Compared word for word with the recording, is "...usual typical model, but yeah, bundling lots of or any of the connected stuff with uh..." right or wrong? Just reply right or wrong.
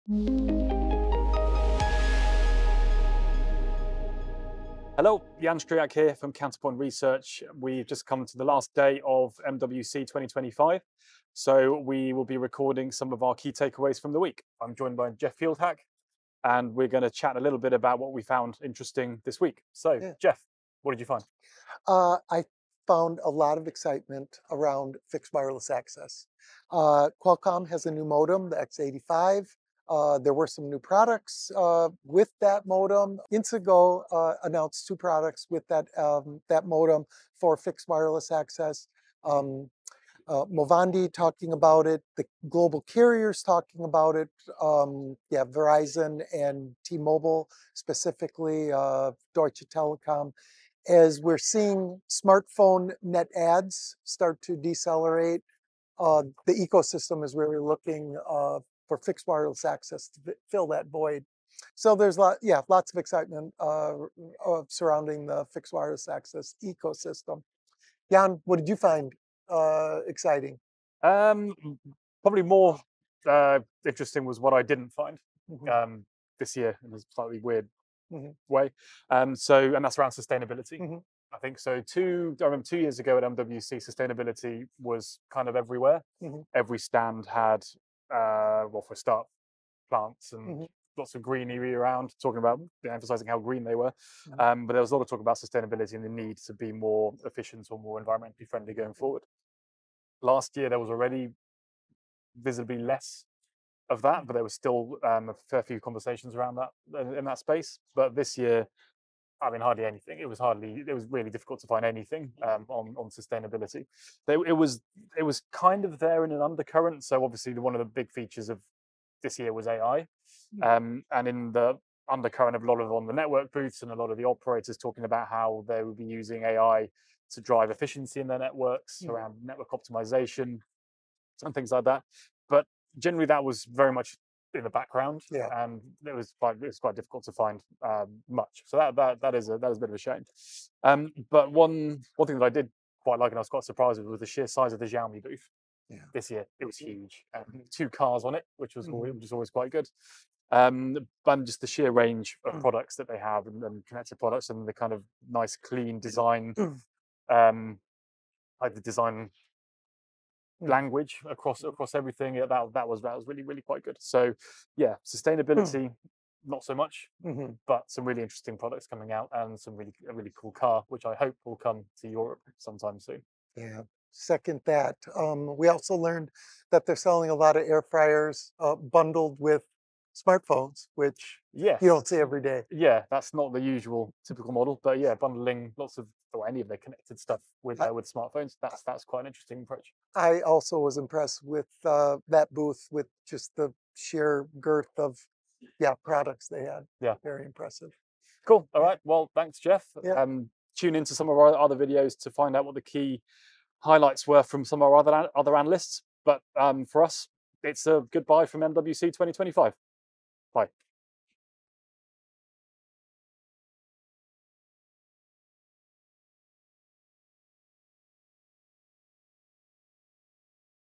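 right.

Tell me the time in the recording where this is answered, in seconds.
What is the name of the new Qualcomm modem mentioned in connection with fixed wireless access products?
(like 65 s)
28 s.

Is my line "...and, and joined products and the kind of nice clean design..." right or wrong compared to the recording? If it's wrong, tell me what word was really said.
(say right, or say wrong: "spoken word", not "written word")
wrong: "connected", not "joined".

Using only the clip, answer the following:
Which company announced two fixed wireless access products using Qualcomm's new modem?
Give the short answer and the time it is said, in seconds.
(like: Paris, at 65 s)
Inseego, at 33 s.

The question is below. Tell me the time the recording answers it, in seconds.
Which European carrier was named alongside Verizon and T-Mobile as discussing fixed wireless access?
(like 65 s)
49 s.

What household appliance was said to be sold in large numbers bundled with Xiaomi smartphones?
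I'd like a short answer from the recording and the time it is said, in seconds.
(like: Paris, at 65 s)
air fryers, at 177 s.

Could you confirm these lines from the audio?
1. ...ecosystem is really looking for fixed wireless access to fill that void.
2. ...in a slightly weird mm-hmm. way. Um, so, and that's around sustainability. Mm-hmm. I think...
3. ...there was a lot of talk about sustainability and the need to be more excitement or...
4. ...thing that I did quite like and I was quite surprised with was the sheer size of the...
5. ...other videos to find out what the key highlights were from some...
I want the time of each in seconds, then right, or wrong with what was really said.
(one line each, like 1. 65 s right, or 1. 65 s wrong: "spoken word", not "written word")
1. 56 s right
2. 76 s right
3. 94 s wrong: "efficient", not "excitement"
4. 142 s right
5. 201 s right.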